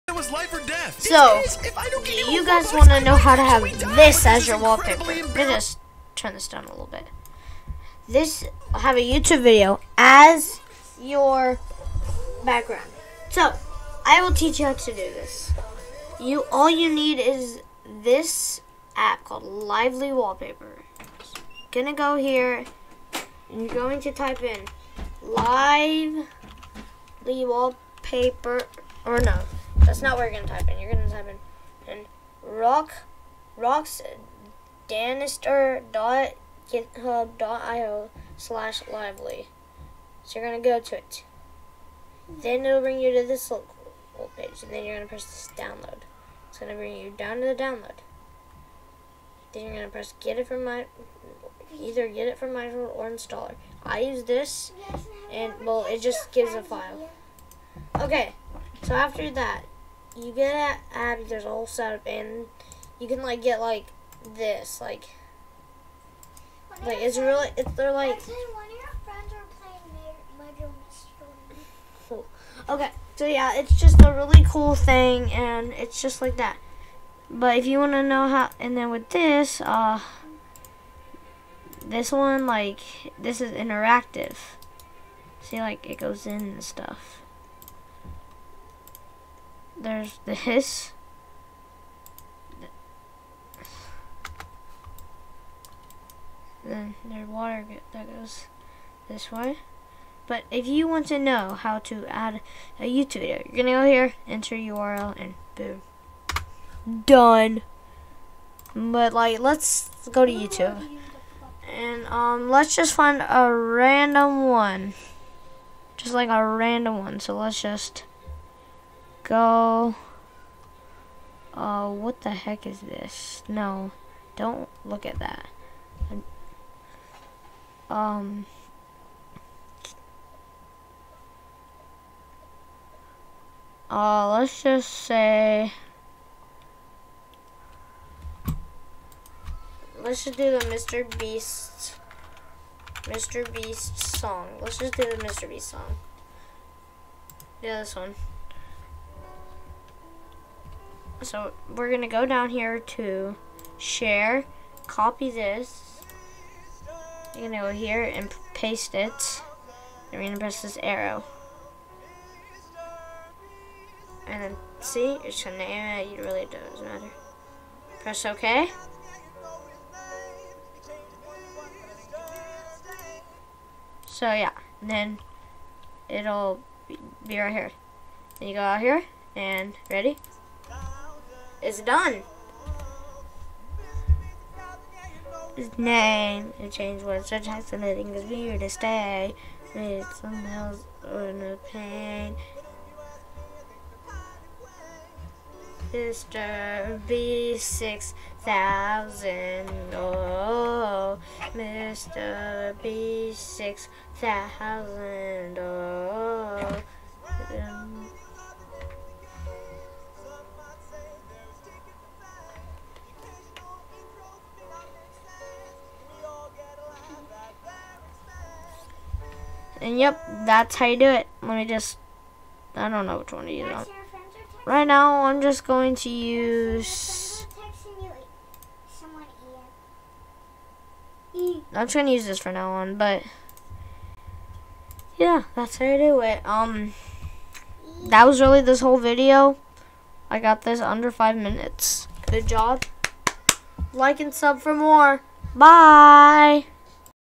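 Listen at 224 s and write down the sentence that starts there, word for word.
Right now, I'm just going to use...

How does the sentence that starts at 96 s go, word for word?
Then there's water that goes this way.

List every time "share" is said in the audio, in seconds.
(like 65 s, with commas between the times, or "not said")
153 s.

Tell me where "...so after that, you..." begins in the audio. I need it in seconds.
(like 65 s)
58 s.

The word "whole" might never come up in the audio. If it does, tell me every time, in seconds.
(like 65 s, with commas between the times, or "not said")
61 s, 238 s.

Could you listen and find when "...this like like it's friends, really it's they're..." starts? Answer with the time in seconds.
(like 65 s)
64 s.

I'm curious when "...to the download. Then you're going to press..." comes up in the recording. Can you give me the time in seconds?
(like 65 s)
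47 s.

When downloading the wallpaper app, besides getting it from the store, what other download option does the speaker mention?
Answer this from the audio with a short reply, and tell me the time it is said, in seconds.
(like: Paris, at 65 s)
installer, at 53 s.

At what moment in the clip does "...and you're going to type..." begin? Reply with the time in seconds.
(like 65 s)
23 s.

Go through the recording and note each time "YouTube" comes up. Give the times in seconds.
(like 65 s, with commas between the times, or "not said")
8 s, 102 s, 110 s.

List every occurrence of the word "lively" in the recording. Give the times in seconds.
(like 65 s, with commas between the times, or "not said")
19 s, 25 s, 38 s.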